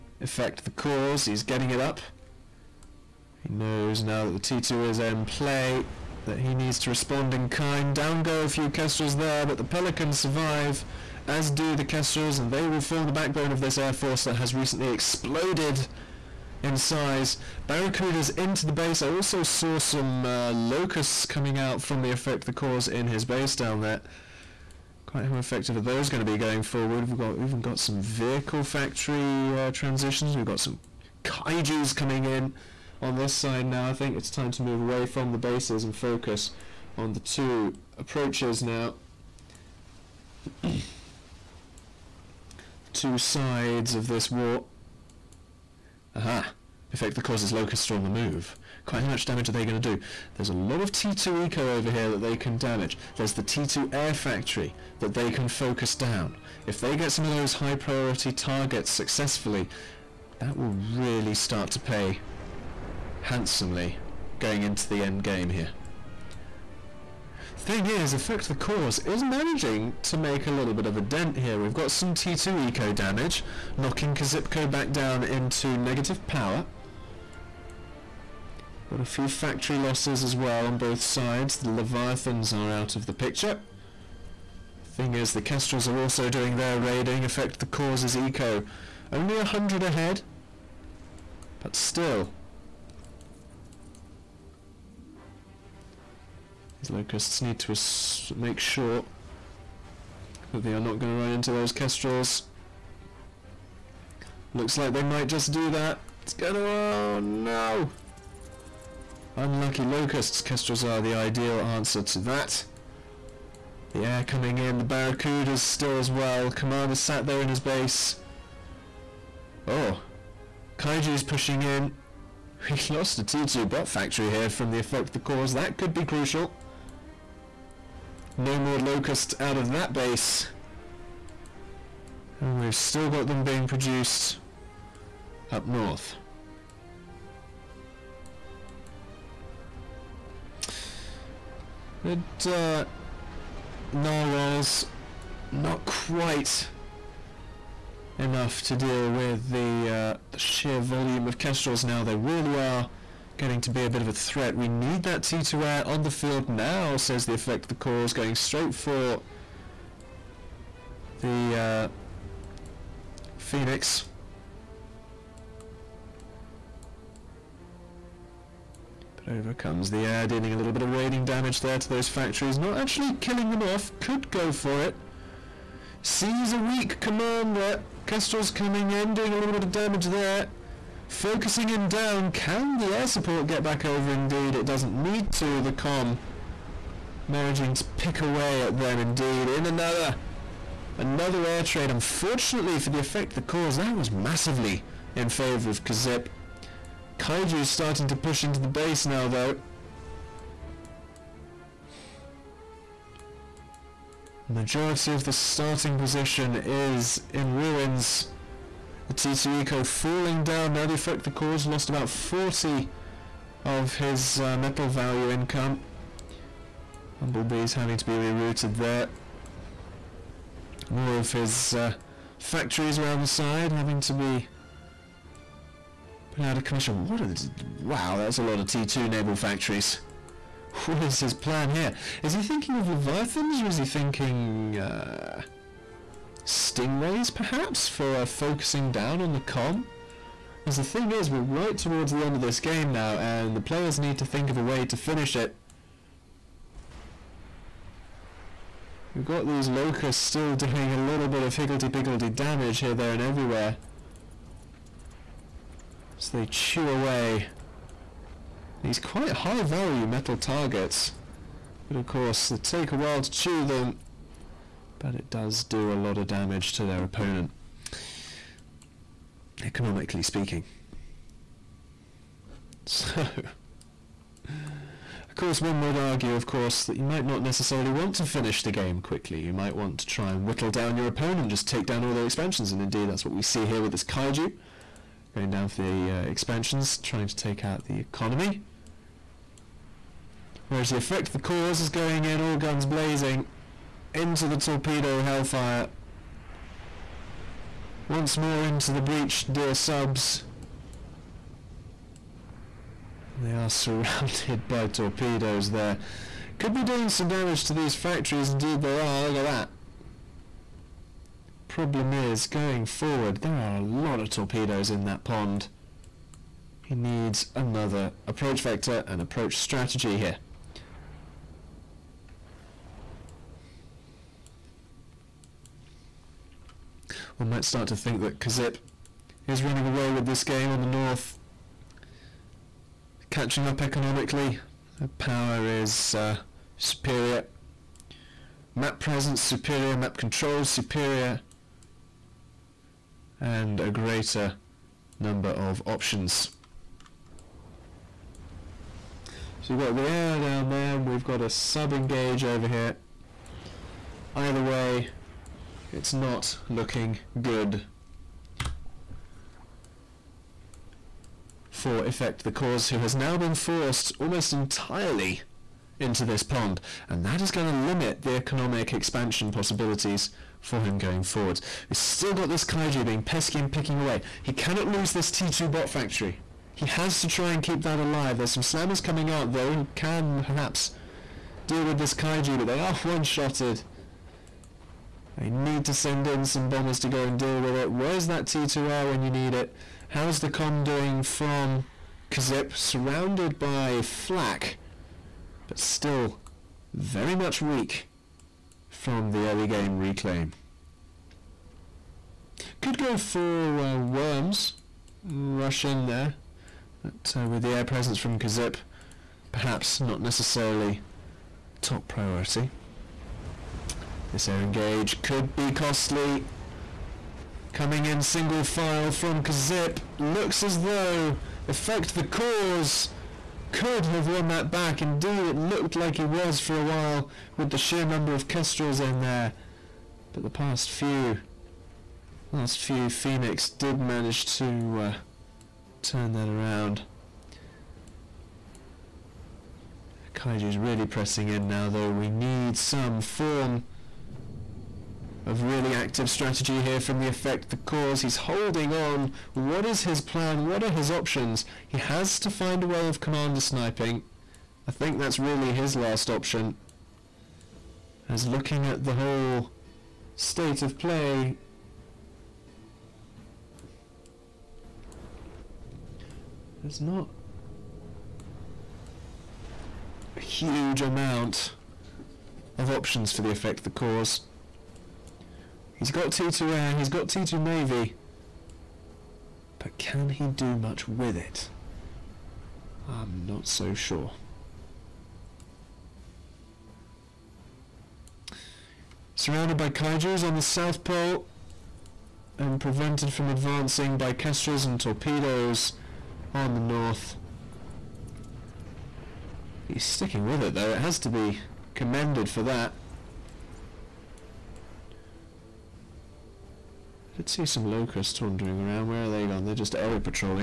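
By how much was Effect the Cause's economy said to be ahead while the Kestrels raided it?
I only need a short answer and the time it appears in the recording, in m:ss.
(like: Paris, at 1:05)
100, at 1:29.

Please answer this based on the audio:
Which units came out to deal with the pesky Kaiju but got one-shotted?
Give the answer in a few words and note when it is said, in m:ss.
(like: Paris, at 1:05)
Slammers, at 6:18.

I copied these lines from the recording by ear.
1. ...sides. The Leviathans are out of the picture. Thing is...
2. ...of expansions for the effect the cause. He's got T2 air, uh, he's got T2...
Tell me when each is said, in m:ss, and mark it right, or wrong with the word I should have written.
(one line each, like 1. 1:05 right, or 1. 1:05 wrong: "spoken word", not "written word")
1. 1:21 right
2. 7:52 wrong: "options", not "expansions".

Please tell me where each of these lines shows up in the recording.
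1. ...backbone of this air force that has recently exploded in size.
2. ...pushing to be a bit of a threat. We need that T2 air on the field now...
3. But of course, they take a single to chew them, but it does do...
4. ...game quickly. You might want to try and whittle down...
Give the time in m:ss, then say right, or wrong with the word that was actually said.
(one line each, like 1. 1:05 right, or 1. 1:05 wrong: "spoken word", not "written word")
1. 0:13 right
2. 2:33 wrong: "getting", not "pushing"
3. 4:21 wrong: "while", not "single"
4. 4:38 right.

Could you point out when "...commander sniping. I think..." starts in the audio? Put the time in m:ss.
7:33.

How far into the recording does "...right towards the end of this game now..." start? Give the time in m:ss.
4:01.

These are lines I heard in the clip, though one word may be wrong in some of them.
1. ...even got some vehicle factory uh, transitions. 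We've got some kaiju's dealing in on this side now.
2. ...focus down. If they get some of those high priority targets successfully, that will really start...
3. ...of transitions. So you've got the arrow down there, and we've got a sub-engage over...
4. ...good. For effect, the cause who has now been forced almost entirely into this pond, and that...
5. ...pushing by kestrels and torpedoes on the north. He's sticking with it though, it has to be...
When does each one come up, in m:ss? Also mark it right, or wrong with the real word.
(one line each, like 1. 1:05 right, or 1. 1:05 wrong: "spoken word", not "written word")
1. 0:27 wrong: "coming", not "dealing"
2. 0:55 right
3. 5:45 wrong: "options", not "transitions"
4. 5:57 right
5. 8:13 wrong: "advancing", not "pushing".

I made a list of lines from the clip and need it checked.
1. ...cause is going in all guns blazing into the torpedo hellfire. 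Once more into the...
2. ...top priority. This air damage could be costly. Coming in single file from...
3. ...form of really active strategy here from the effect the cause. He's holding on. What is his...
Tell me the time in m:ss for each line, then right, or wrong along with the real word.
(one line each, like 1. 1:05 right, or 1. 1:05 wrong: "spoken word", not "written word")
1. 4:51 right
2. 6:51 wrong: "engage", not "damage"
3. 7:23 right.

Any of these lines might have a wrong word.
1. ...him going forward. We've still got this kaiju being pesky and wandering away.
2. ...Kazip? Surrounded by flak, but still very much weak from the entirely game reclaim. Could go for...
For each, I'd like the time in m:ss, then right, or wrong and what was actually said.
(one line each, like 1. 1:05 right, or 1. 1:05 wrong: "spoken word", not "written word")
1. 6:10 wrong: "picking", not "wandering"
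2. 6:32 wrong: "early", not "entirely".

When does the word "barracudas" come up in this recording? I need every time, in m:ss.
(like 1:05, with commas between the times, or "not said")
0:17, 1:54.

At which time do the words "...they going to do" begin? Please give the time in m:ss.
0:49.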